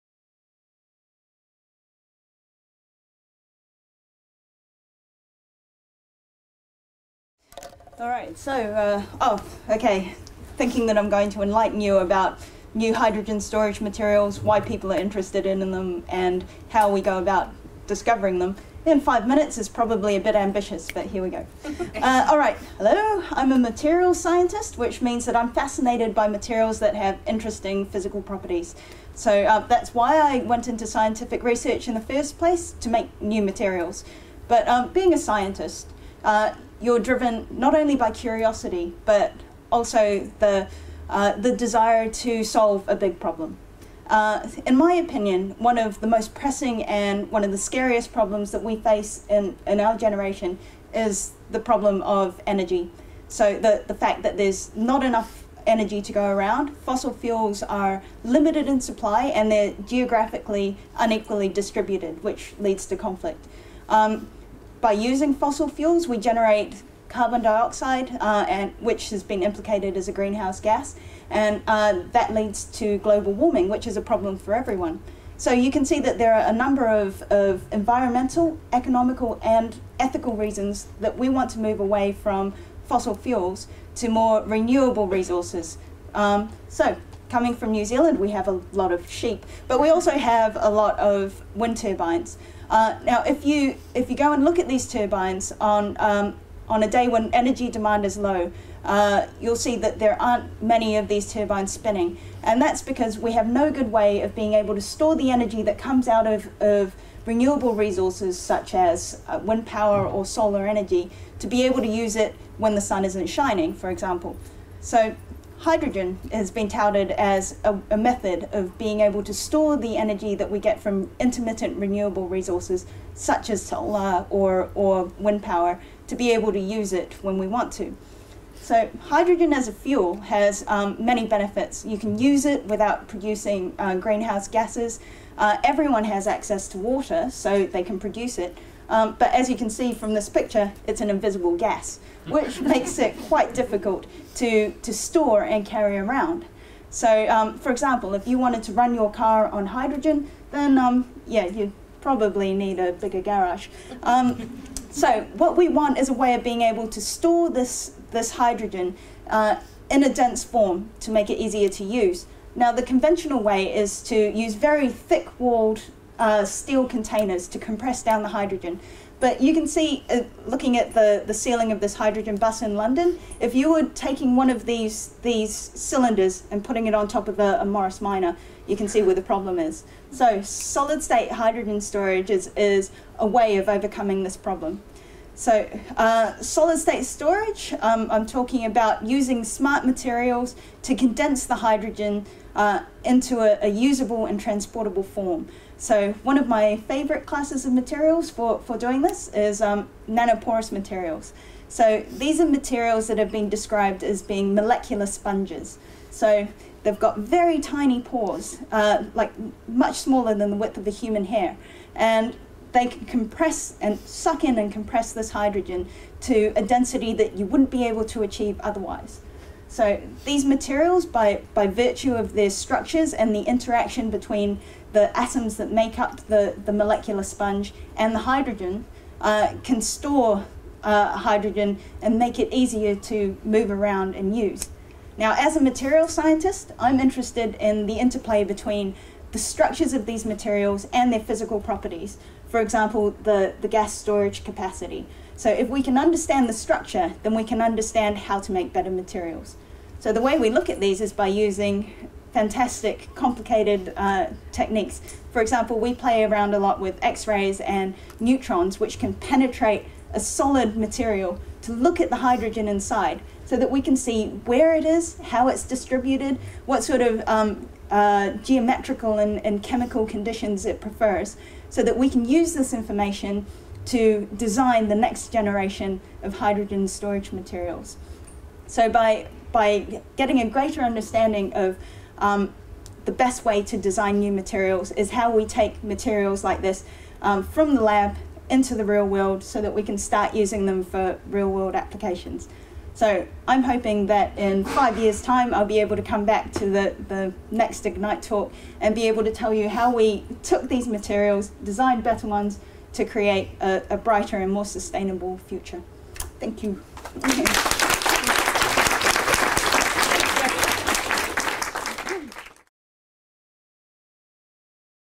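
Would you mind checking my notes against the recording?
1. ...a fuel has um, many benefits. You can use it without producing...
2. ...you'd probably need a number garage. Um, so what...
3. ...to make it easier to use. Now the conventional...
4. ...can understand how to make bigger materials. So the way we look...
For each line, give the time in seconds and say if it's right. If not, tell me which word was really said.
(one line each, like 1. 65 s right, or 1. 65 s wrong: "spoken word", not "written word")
1. 129 s right
2. 151 s wrong: "bigger", not "number"
3. 160 s right
4. 247 s wrong: "better", not "bigger".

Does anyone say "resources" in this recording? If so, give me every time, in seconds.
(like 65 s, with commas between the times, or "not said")
85 s, 107 s, 122 s.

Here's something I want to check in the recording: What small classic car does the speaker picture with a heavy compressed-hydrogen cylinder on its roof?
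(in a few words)
Morris Minor.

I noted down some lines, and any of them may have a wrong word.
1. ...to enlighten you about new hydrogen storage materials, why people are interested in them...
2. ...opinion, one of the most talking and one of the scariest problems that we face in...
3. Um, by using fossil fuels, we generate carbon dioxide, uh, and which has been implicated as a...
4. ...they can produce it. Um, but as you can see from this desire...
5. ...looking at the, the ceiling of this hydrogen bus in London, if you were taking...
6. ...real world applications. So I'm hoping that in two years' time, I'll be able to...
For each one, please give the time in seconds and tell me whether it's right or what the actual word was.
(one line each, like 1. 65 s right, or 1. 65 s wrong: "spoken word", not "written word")
1. 11 s right
2. 44 s wrong: "pressing", not "talking"
3. 63 s right
4. 137 s wrong: "picture", not "desire"
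5. 170 s right
6. 291 s wrong: "five", not "two".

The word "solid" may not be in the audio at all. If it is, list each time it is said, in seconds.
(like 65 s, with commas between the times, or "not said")
180 s, 186 s, 260 s.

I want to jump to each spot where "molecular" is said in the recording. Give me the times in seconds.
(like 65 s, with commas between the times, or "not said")
204 s, 226 s.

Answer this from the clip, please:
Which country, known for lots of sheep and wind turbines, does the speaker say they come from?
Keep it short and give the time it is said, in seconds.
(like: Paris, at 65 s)
New Zealand, at 87 s.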